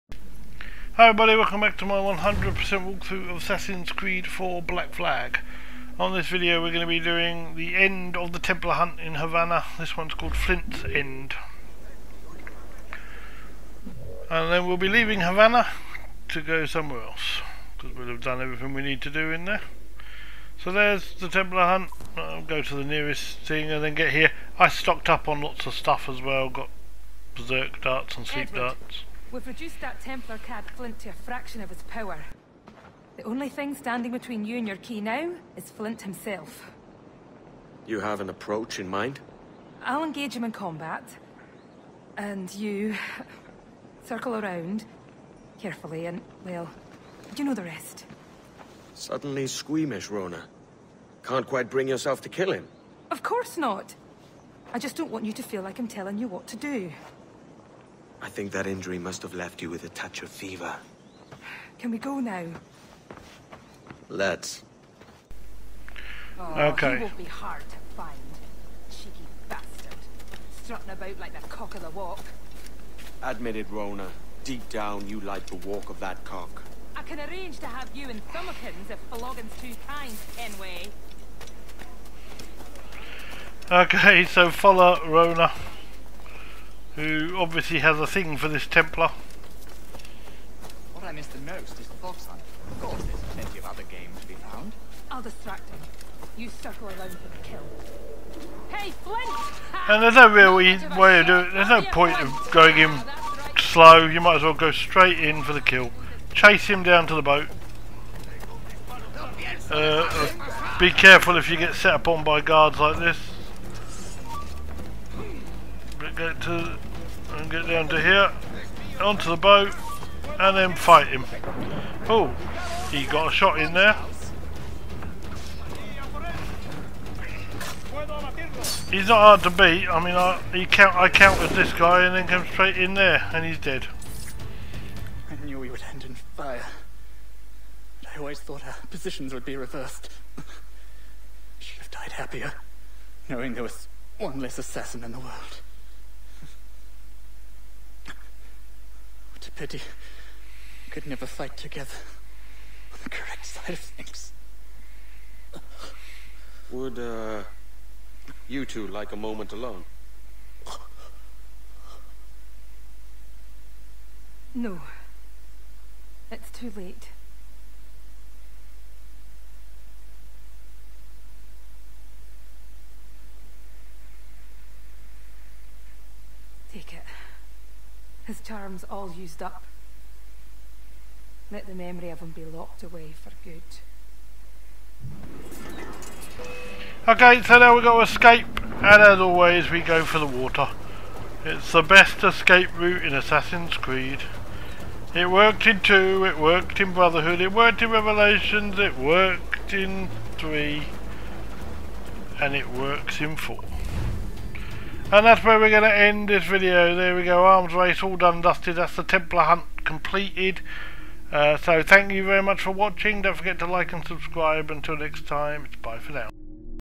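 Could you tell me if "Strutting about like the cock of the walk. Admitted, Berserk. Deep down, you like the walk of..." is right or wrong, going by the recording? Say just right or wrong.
wrong.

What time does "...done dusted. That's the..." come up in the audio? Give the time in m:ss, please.
3:28.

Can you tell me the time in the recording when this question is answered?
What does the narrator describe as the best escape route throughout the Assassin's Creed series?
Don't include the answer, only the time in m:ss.
3:10.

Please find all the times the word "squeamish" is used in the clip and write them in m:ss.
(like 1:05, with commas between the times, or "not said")
0:49.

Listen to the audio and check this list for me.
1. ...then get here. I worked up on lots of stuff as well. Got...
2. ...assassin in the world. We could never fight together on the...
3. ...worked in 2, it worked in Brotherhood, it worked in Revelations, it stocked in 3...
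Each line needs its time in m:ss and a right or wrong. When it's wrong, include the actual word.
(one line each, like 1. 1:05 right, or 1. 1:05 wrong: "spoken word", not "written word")
1. 0:23 wrong: "stocked", not "worked"
2. 2:24 right
3. 3:15 wrong: "worked", not "stocked".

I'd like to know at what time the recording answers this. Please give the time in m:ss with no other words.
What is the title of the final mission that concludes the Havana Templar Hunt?
0:10.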